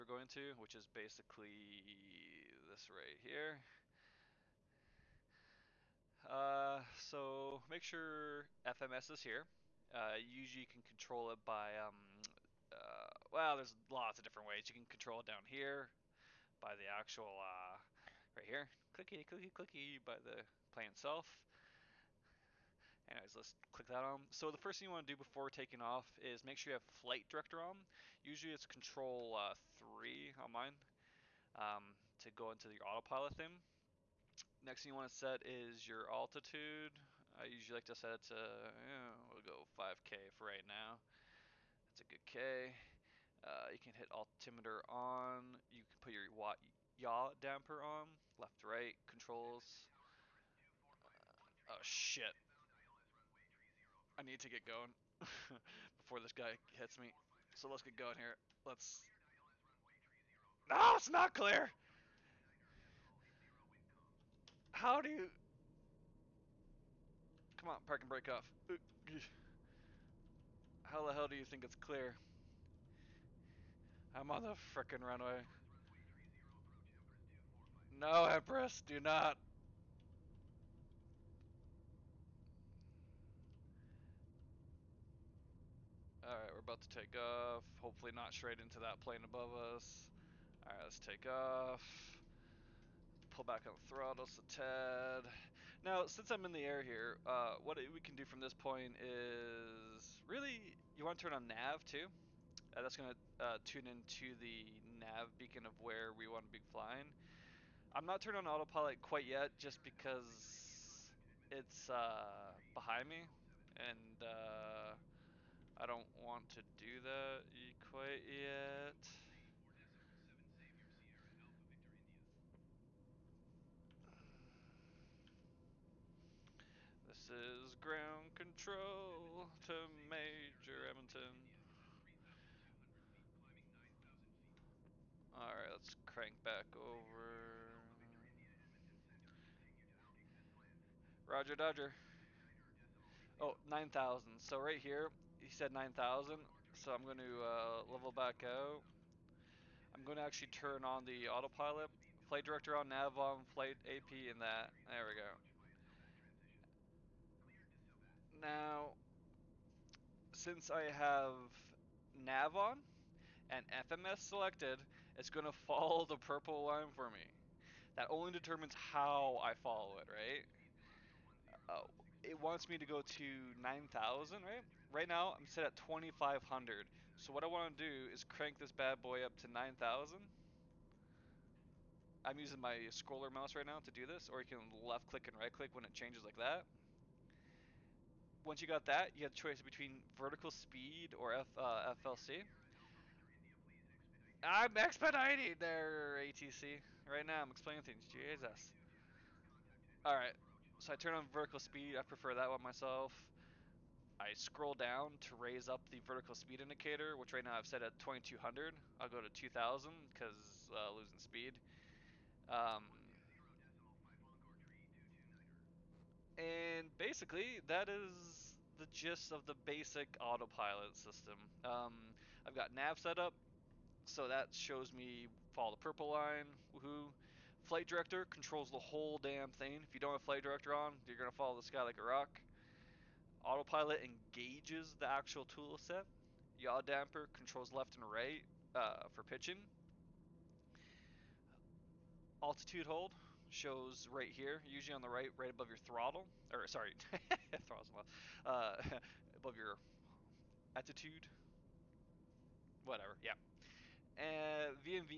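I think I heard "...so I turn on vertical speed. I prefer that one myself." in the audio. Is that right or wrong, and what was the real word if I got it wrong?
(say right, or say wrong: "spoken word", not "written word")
right.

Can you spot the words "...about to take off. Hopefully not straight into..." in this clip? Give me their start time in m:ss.
1:26.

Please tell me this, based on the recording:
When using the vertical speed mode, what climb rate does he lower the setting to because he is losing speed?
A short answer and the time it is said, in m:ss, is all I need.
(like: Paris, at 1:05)
2000, at 3:29.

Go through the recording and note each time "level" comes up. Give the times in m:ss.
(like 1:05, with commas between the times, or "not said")
2:27.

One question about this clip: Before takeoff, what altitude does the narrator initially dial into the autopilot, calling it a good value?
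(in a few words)
5K.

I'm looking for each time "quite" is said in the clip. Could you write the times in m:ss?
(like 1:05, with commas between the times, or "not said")
1:48, 1:57.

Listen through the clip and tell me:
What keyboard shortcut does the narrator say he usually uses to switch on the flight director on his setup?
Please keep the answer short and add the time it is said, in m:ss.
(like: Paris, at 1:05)
Control 3, at 0:28.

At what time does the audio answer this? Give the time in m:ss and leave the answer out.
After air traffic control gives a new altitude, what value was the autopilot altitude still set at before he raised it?
2:55.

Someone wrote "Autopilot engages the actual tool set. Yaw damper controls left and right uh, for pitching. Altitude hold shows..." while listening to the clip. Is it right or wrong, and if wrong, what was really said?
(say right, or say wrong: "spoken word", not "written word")
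right.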